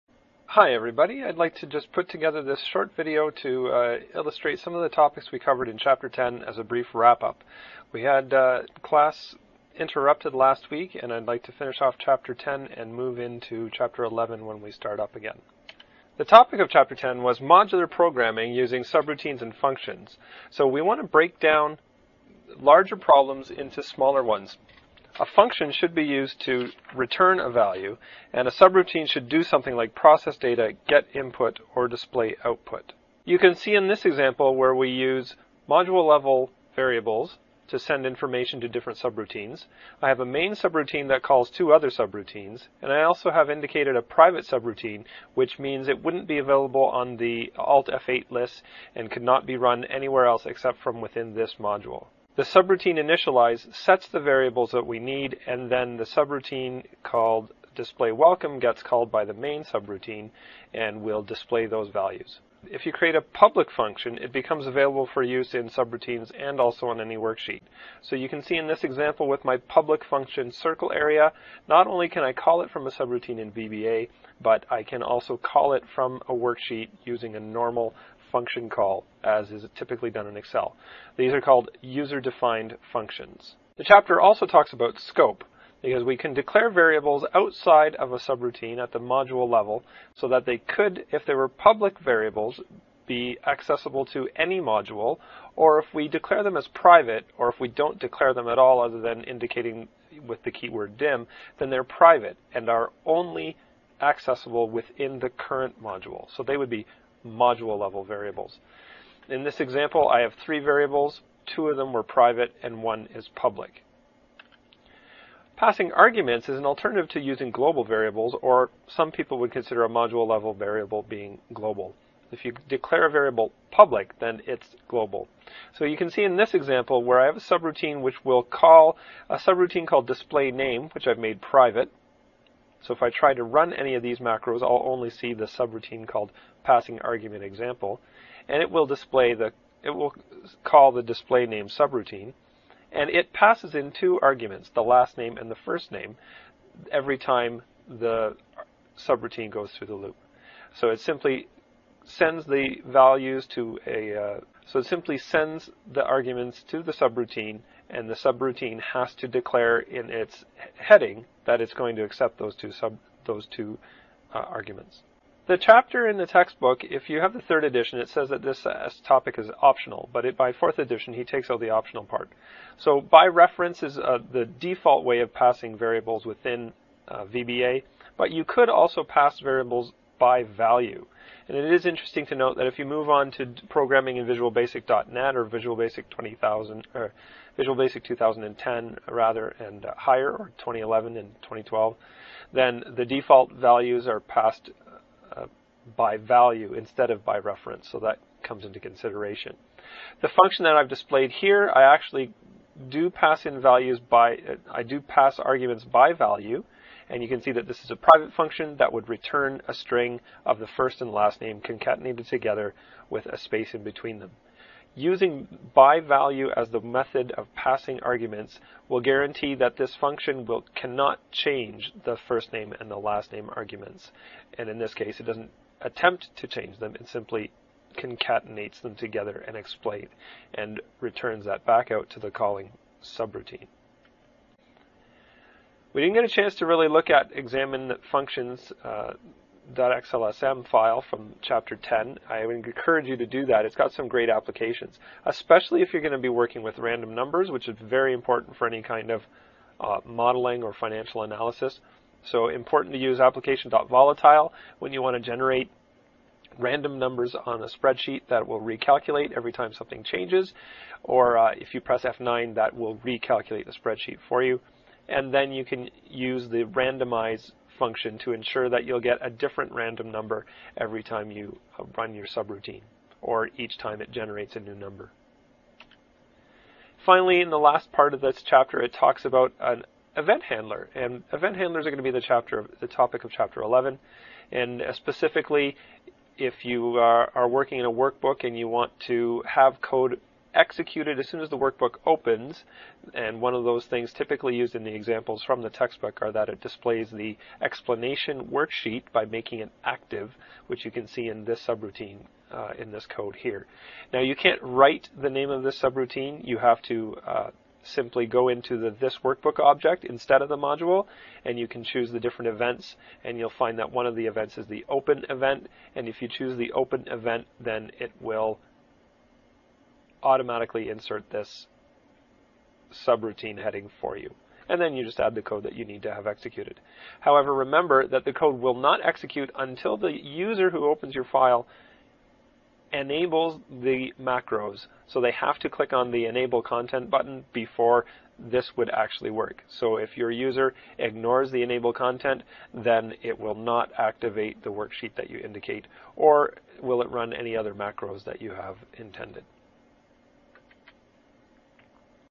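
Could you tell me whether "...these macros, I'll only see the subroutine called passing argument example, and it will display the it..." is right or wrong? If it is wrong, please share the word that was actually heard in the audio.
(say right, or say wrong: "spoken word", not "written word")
right.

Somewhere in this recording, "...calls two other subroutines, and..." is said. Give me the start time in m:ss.
0:41.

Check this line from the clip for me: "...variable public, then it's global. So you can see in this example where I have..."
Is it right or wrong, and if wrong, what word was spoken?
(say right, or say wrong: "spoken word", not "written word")
right.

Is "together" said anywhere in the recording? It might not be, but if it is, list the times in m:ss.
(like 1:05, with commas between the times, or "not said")
0:02, 3:32, 3:48.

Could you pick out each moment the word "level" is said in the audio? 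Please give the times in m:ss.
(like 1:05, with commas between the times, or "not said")
0:36, 1:29, 1:47, 2:00.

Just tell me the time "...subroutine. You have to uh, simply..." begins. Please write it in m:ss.
5:05.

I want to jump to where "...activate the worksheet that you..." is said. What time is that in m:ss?
5:43.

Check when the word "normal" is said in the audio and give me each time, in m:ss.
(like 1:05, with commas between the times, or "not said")
1:17.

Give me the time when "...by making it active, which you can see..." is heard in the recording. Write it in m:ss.
4:59.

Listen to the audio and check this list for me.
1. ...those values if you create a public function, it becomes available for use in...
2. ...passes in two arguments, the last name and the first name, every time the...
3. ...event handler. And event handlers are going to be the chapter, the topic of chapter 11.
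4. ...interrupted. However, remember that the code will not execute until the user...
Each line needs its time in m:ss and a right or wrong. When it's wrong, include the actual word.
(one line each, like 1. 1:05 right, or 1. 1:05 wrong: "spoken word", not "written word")
1. 1:01 right
2. 2:23 right
3. 4:40 right
4. 5:26 wrong: "executed", not "interrupted".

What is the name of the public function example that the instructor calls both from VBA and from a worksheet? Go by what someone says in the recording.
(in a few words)
circle area.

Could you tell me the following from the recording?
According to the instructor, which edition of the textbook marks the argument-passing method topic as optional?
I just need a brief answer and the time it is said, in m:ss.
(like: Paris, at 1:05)
third edition, at 2:47.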